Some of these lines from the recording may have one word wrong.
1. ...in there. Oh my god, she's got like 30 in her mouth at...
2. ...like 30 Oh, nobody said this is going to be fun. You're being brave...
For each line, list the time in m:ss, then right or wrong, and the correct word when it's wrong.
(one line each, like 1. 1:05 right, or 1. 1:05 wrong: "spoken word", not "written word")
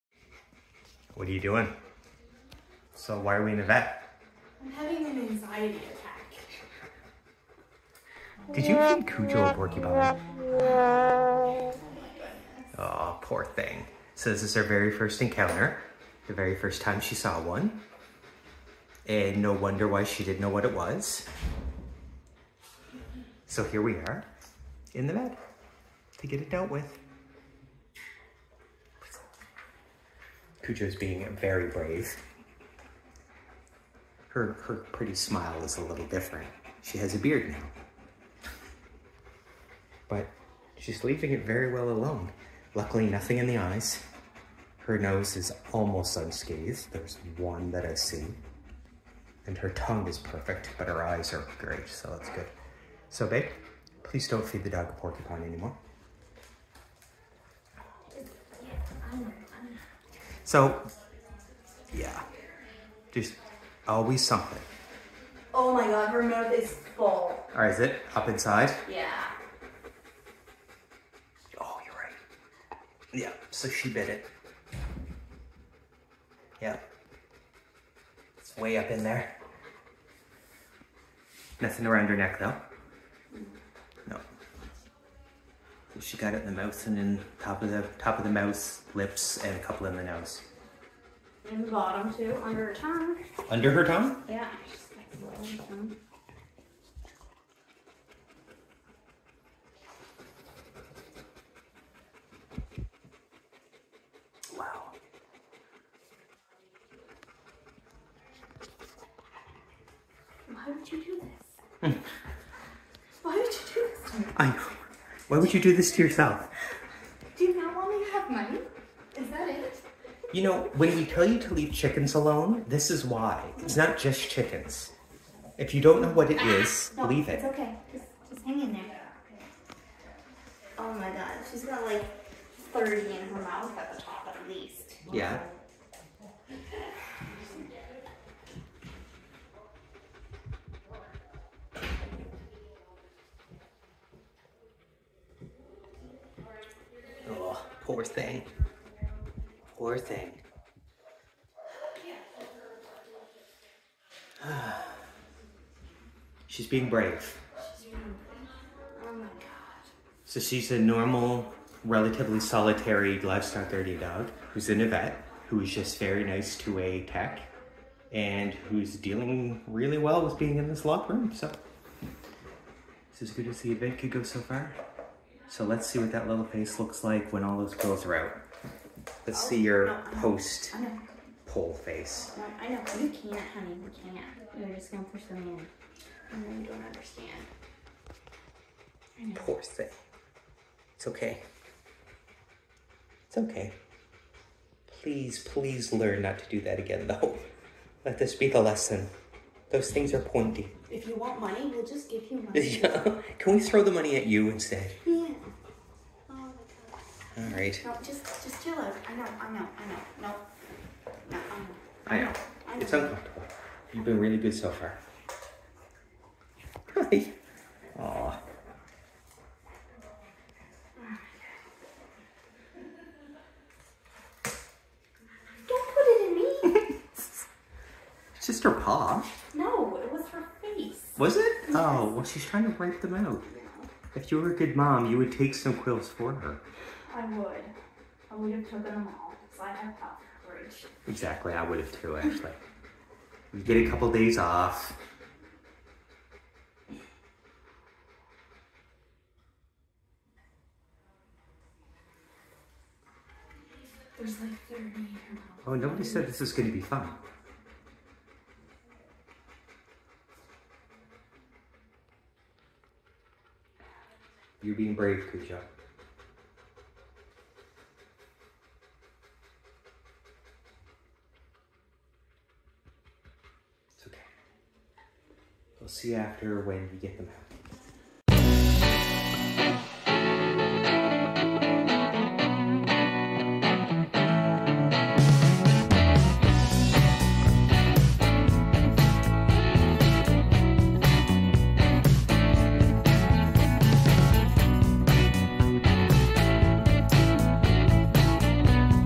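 1. 2:08 right
2. 4:14 right.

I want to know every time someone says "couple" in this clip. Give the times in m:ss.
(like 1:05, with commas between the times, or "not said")
1:29, 4:03.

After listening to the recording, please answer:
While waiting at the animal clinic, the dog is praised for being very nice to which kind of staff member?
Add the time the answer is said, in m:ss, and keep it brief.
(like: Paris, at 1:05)
tech, at 2:47.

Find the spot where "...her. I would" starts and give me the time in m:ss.
3:56.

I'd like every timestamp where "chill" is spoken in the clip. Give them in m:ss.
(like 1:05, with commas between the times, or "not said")
3:28.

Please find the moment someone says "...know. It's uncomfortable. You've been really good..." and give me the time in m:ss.
3:32.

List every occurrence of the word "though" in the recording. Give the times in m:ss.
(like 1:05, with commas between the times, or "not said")
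1:22, 3:17.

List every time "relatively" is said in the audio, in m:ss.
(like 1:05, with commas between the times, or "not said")
2:41.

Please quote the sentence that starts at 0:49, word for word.
And her tongue is perfect, but her eyes are great, so that's good.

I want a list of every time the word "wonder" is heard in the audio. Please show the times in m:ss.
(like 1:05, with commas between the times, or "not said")
0:19.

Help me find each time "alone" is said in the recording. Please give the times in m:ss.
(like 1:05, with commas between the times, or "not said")
0:41, 2:02.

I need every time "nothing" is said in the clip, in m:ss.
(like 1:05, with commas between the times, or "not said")
0:43, 1:21.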